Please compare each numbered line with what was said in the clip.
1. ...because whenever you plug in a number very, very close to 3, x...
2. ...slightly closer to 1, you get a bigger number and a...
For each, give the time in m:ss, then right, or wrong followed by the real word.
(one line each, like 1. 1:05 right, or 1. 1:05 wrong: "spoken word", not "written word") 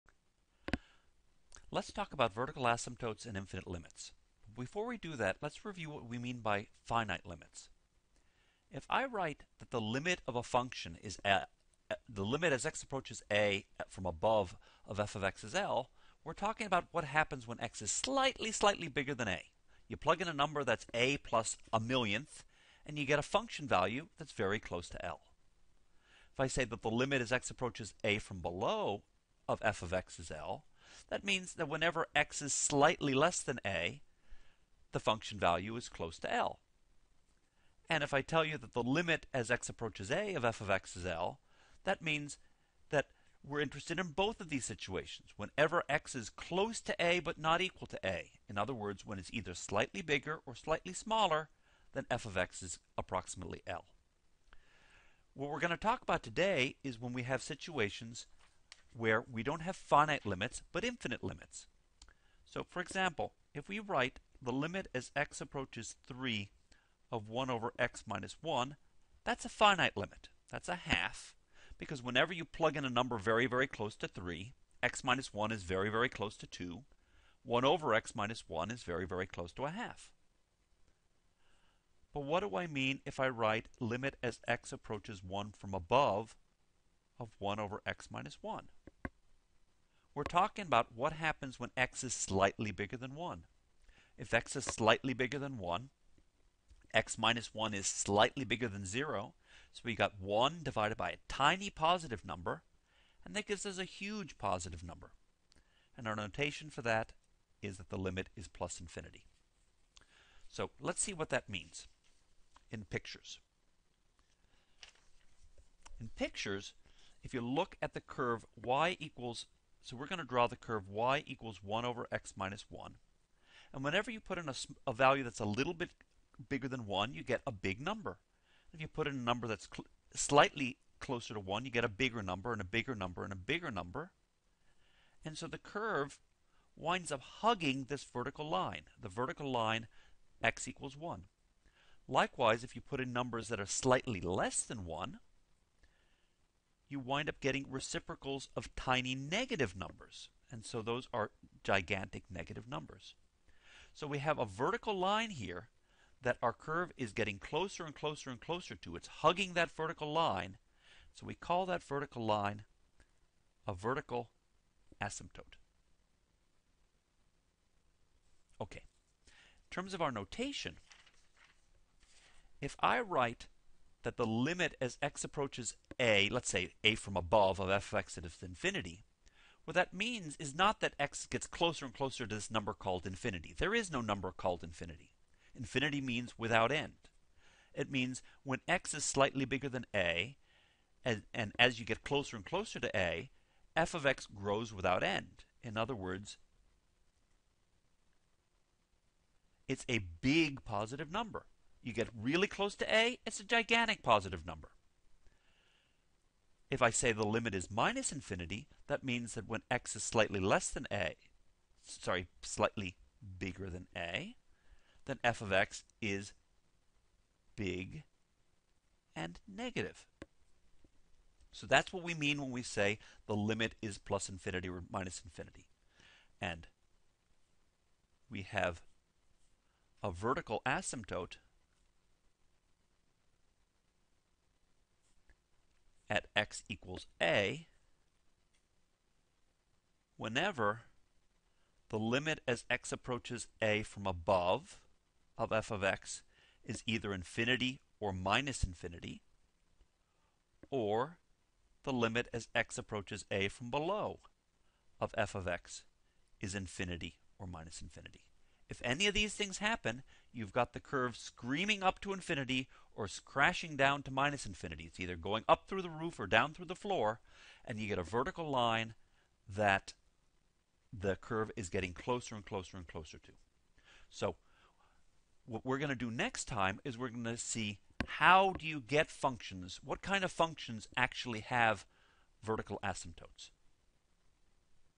1. 1:11 right
2. 2:10 right.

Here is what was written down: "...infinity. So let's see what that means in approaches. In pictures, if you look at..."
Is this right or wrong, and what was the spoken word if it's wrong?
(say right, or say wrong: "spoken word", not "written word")
wrong: "pictures", not "approaches".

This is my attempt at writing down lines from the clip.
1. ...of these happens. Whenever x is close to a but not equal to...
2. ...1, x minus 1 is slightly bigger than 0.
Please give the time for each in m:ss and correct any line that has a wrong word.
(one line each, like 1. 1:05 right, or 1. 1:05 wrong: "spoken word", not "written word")
1. 0:44 wrong: "situations", not "happens"
2. 1:35 right.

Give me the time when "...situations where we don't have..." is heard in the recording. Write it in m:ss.
0:57.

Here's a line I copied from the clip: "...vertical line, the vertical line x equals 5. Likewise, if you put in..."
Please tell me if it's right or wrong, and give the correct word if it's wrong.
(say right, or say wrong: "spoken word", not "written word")
wrong: "1", not "5".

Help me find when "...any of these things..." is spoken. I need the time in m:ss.
4:18.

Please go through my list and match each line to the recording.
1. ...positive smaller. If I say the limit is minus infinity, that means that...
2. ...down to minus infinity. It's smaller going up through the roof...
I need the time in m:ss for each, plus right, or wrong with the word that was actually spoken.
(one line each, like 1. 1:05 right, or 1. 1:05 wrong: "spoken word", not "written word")
1. 3:24 wrong: "number", not "smaller"
2. 4:23 wrong: "either", not "smaller".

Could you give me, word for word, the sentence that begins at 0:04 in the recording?
Before we do that, let's review what we mean by finite limits.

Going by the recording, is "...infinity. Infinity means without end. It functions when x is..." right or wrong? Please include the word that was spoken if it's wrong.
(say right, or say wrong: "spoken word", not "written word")
wrong: "means", not "functions".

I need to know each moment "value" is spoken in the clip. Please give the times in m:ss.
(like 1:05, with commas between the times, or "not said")
0:23, 0:35, 2:04.